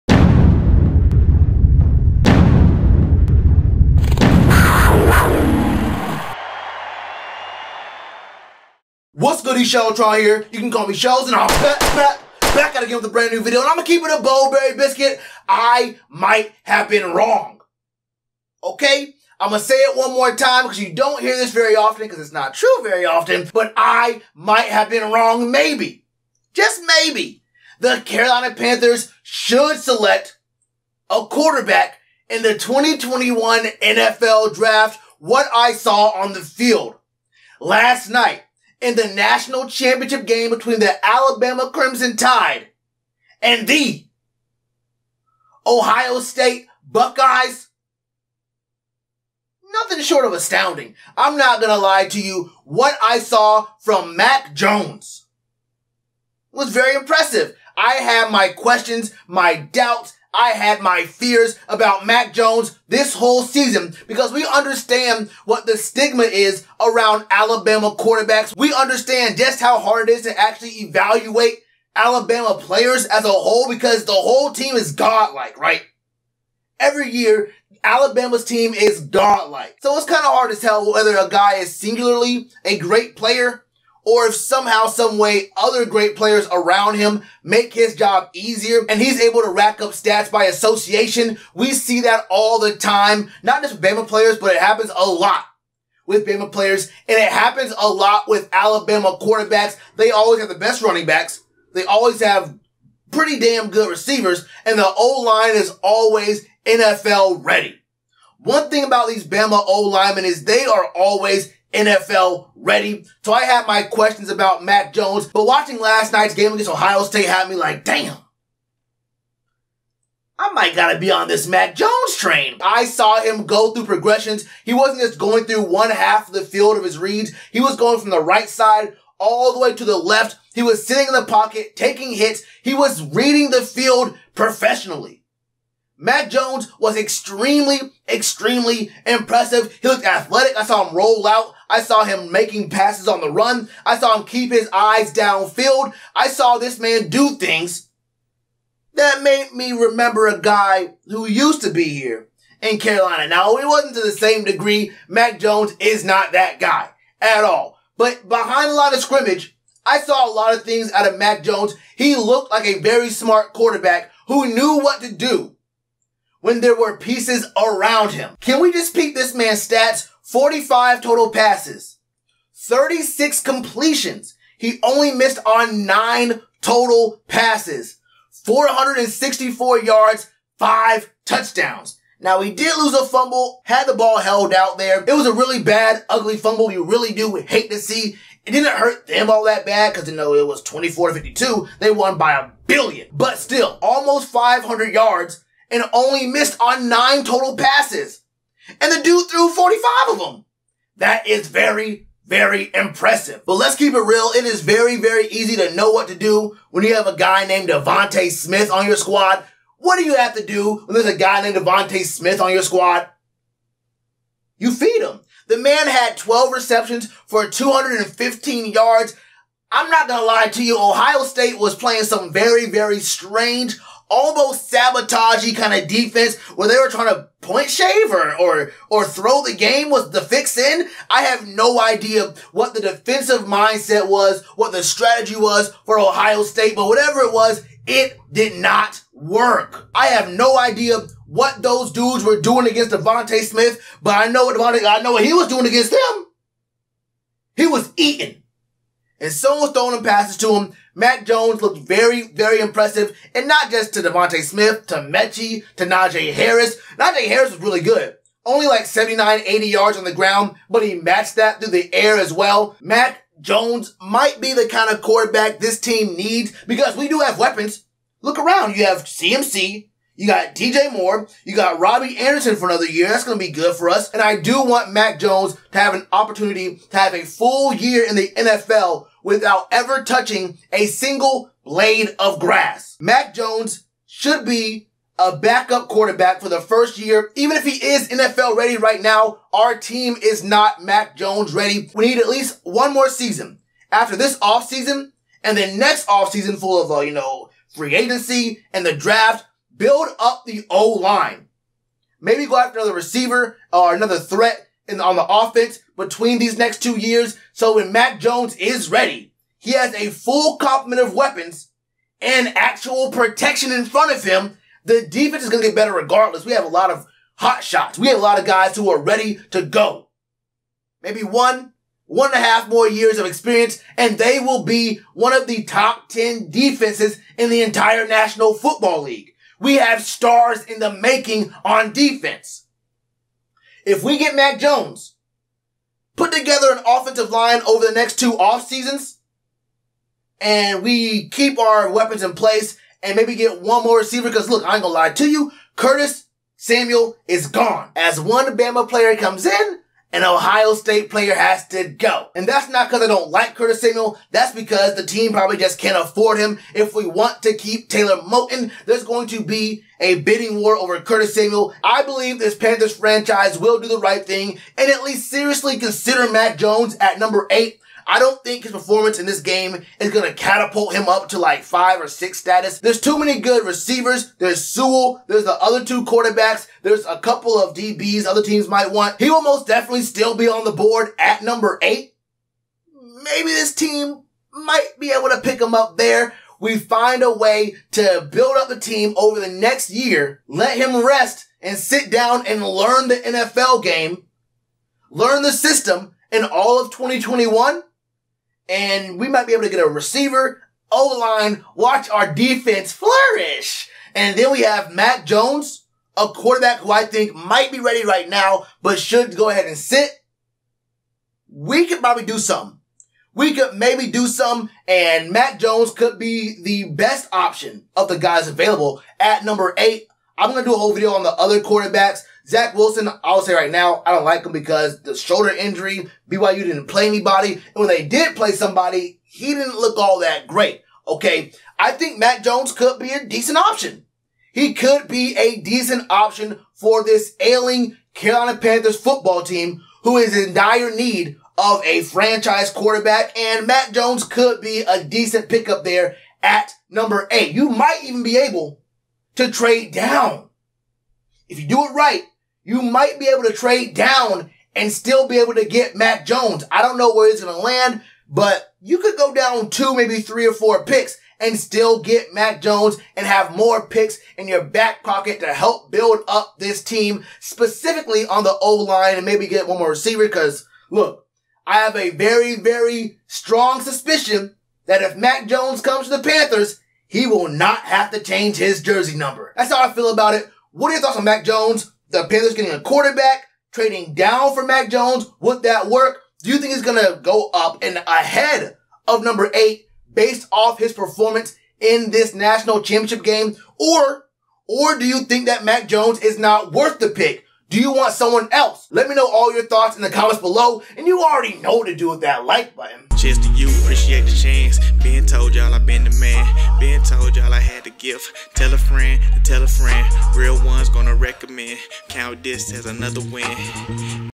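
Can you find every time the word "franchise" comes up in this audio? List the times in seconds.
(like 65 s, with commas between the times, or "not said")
362 s, 442 s.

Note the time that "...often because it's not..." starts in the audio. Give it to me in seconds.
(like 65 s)
21 s.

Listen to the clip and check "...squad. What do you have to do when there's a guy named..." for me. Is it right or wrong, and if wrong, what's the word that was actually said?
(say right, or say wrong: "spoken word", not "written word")
right.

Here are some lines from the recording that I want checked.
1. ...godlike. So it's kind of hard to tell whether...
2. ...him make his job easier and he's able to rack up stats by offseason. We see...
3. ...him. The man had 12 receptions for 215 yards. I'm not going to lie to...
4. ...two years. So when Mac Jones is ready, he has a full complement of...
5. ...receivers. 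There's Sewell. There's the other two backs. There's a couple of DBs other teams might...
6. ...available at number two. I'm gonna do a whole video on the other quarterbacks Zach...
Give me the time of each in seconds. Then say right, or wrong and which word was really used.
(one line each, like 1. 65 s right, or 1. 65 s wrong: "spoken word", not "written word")
1. 79 s right
2. 86 s wrong: "association", not "offseason"
3. 215 s right
4. 306 s right
5. 373 s wrong: "quarterbacks", not "backs"
6. 418 s wrong: "eight", not "two".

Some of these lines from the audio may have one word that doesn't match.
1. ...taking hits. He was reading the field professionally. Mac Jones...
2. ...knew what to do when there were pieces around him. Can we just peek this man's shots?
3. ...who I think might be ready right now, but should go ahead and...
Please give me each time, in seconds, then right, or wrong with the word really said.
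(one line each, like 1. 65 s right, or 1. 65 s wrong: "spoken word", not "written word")
1. 131 s right
2. 164 s wrong: "stats", not "shots"
3. 406 s right.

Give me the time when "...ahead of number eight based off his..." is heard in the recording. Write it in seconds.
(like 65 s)
488 s.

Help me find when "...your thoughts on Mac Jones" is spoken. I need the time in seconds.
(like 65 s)
480 s.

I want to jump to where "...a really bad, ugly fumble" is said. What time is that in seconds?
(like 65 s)
185 s.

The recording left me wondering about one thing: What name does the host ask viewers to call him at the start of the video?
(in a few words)
Shells.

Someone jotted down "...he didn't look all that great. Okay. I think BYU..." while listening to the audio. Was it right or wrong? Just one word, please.
wrong.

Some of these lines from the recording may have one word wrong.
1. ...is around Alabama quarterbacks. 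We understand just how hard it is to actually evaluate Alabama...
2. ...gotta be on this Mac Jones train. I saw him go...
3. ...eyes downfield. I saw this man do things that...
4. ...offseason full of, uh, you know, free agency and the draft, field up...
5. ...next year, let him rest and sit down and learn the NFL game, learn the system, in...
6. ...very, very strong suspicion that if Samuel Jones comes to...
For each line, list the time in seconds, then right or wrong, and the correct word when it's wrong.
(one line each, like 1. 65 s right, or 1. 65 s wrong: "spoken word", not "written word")
1. 66 s right
2. 120 s right
3. 144 s right
4. 296 s wrong: "build", not "field"
5. 389 s right
6. 472 s wrong: "Mac", not "Samuel".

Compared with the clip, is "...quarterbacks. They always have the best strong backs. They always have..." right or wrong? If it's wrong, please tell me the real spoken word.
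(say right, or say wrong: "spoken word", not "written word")
wrong: "running", not "strong".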